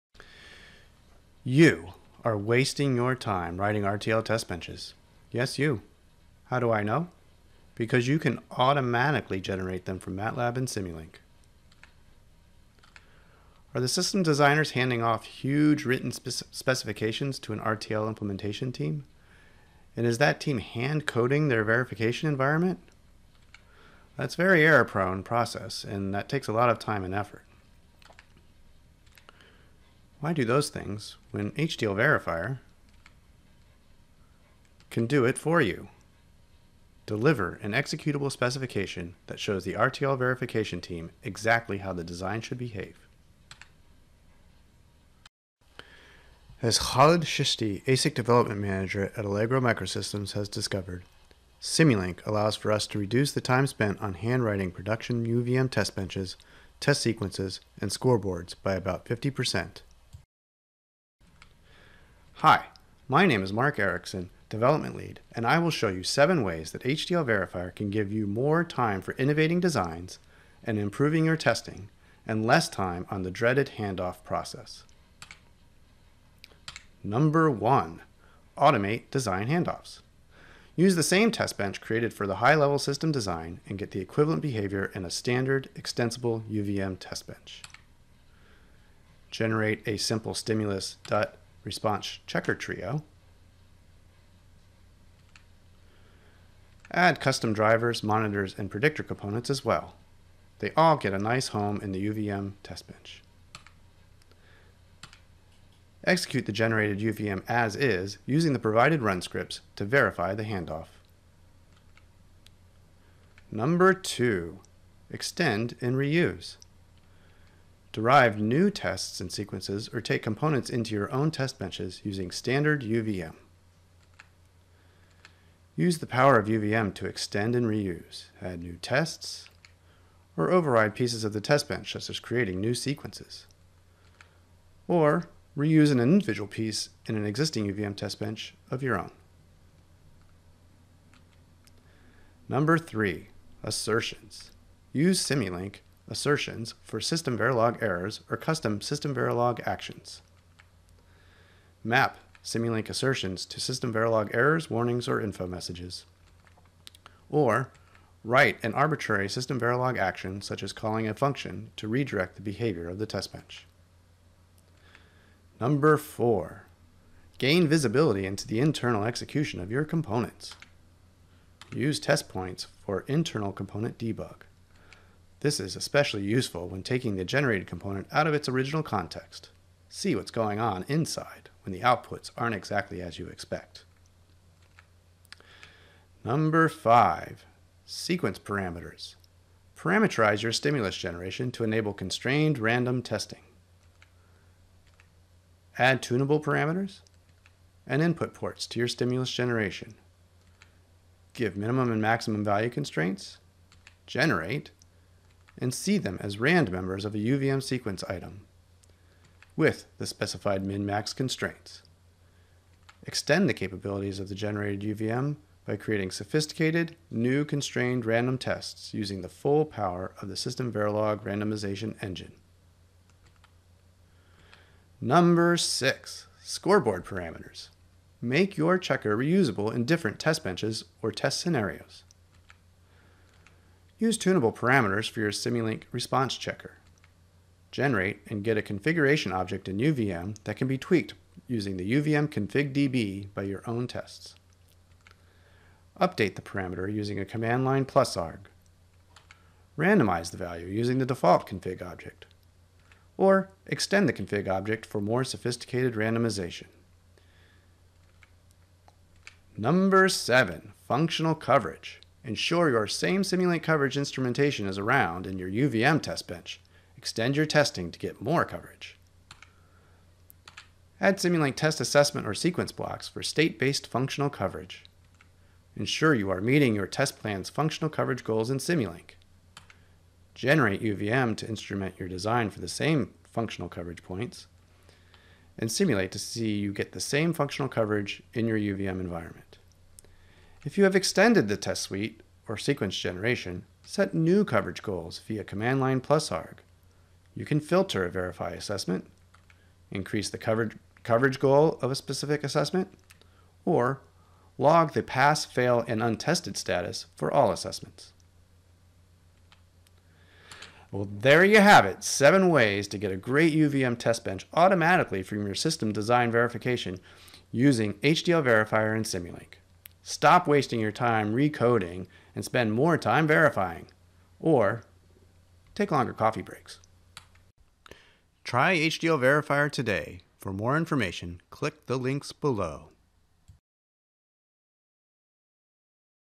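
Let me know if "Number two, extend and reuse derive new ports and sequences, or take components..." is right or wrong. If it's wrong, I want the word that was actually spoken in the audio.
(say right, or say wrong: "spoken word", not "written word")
wrong: "tests", not "ports".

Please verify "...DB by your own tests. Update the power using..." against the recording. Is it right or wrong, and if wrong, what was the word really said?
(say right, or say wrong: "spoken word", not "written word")
wrong: "parameter", not "power".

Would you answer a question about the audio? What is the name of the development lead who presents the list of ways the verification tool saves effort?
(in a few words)
Mark Erickson.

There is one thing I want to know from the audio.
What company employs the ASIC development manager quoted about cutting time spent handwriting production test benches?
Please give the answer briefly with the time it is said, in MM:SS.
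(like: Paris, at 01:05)
Allegro Microsystems, at 00:49.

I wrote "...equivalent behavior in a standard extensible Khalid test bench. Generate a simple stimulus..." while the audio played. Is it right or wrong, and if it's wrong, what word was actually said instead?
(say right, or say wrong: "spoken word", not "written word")
wrong: "UVM", not "Khalid".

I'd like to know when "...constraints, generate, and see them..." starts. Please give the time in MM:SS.
03:22.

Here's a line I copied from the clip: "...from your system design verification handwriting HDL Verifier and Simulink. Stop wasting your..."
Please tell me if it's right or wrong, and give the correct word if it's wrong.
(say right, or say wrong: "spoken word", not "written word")
wrong: "using", not "handwriting".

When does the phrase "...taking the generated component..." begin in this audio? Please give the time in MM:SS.
02:56.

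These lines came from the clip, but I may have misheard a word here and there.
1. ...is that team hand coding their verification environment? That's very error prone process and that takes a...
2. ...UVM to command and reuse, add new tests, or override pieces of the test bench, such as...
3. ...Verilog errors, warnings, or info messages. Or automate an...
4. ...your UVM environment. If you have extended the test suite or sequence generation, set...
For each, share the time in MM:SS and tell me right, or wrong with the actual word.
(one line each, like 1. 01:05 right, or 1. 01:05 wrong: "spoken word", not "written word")
1. 00:20 right
2. 02:06 wrong: "extend", not "command"
3. 02:33 wrong: "write", not "automate"
4. 04:48 right.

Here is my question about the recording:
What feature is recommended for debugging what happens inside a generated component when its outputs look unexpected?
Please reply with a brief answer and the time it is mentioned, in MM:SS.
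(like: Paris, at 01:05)
Test points, at 02:52.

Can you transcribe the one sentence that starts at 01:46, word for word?
Execute the generated UVM as is using the provided run scripts to verify the handoff.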